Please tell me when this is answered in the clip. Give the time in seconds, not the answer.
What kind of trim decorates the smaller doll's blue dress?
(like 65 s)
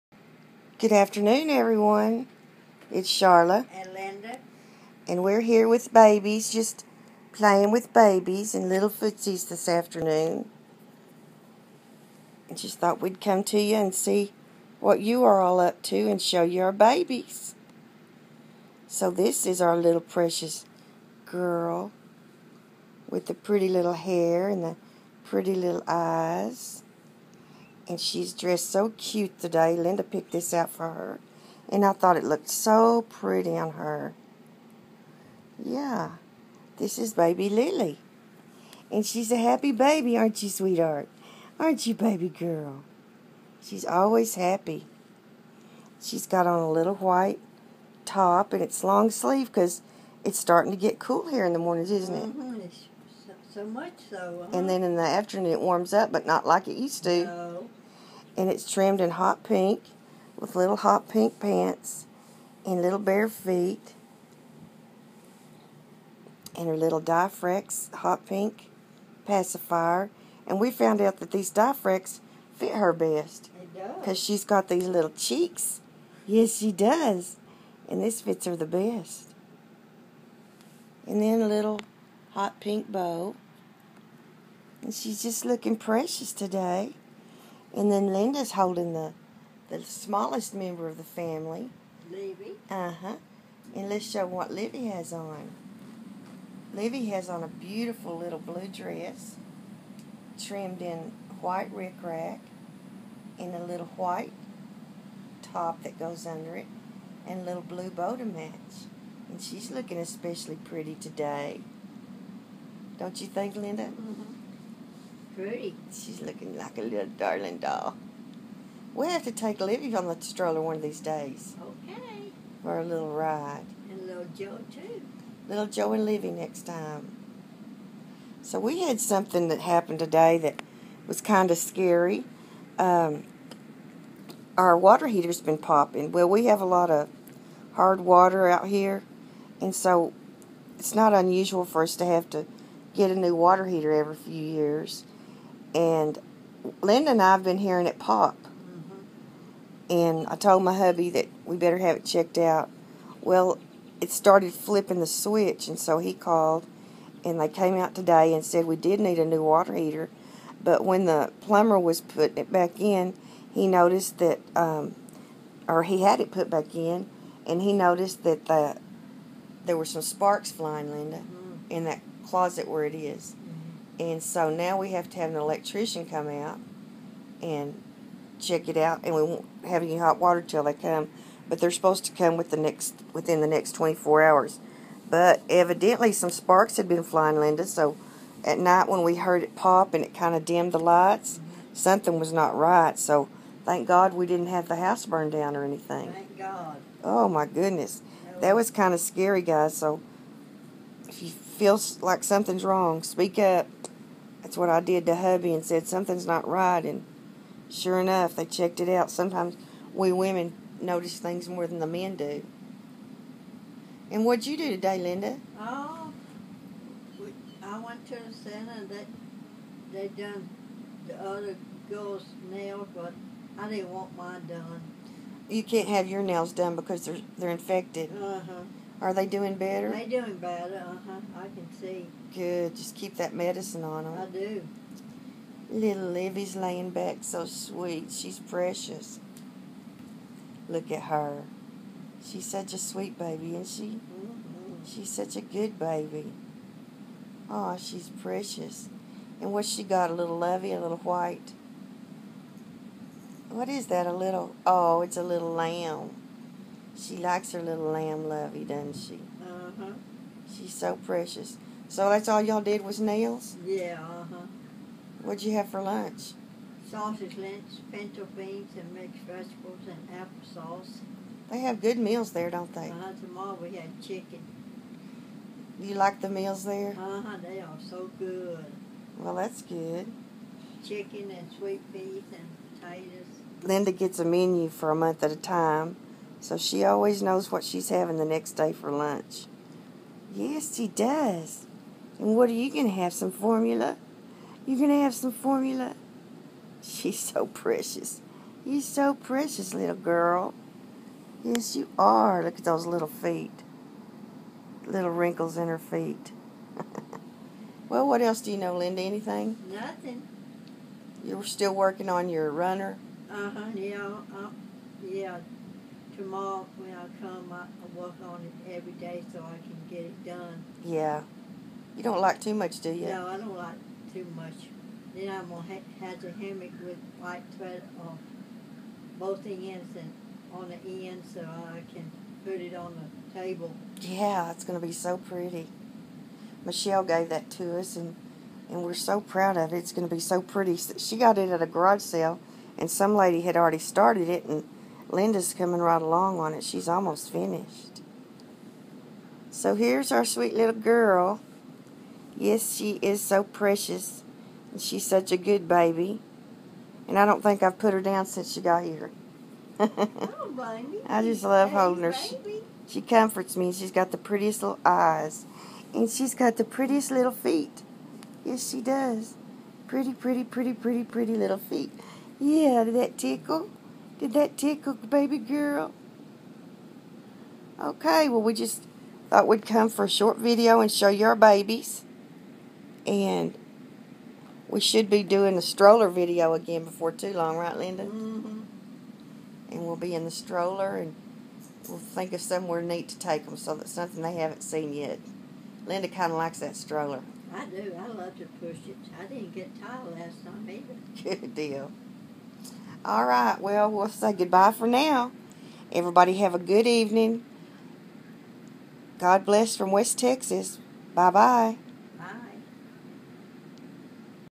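101 s.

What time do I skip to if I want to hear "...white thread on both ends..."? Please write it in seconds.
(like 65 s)
327 s.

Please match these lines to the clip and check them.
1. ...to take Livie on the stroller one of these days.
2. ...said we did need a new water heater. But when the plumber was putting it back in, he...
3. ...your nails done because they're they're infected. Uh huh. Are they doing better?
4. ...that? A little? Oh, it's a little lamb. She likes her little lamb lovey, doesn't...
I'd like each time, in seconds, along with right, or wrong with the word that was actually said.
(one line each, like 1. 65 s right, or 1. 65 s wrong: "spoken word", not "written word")
1. 119 s right
2. 158 s right
3. 226 s right
4. 253 s right.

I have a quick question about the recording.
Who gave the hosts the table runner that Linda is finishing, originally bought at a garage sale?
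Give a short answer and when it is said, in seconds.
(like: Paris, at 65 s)
Michelle, at 336 s.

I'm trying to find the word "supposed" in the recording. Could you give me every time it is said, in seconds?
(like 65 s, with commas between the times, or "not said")
181 s.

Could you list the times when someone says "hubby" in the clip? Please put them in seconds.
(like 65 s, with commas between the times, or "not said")
150 s, 205 s.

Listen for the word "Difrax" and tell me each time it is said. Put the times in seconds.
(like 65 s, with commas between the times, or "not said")
67 s, 71 s.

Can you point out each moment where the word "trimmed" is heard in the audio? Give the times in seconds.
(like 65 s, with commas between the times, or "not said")
58 s, 100 s.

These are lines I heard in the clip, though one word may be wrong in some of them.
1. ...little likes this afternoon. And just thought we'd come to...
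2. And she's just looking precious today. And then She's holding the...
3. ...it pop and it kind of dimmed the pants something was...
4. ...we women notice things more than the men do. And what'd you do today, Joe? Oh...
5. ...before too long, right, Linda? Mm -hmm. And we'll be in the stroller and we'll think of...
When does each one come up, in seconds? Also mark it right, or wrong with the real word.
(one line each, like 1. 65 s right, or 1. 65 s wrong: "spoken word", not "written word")
1. 8 s wrong: "footsies", not "likes"
2. 84 s wrong: "Linda", not "She"
3. 189 s wrong: "lights", not "pants"
4. 209 s wrong: "Linda", not "Joe"
5. 386 s right.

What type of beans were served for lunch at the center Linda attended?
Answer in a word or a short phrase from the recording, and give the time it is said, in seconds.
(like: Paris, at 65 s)
pinto beans, at 267 s.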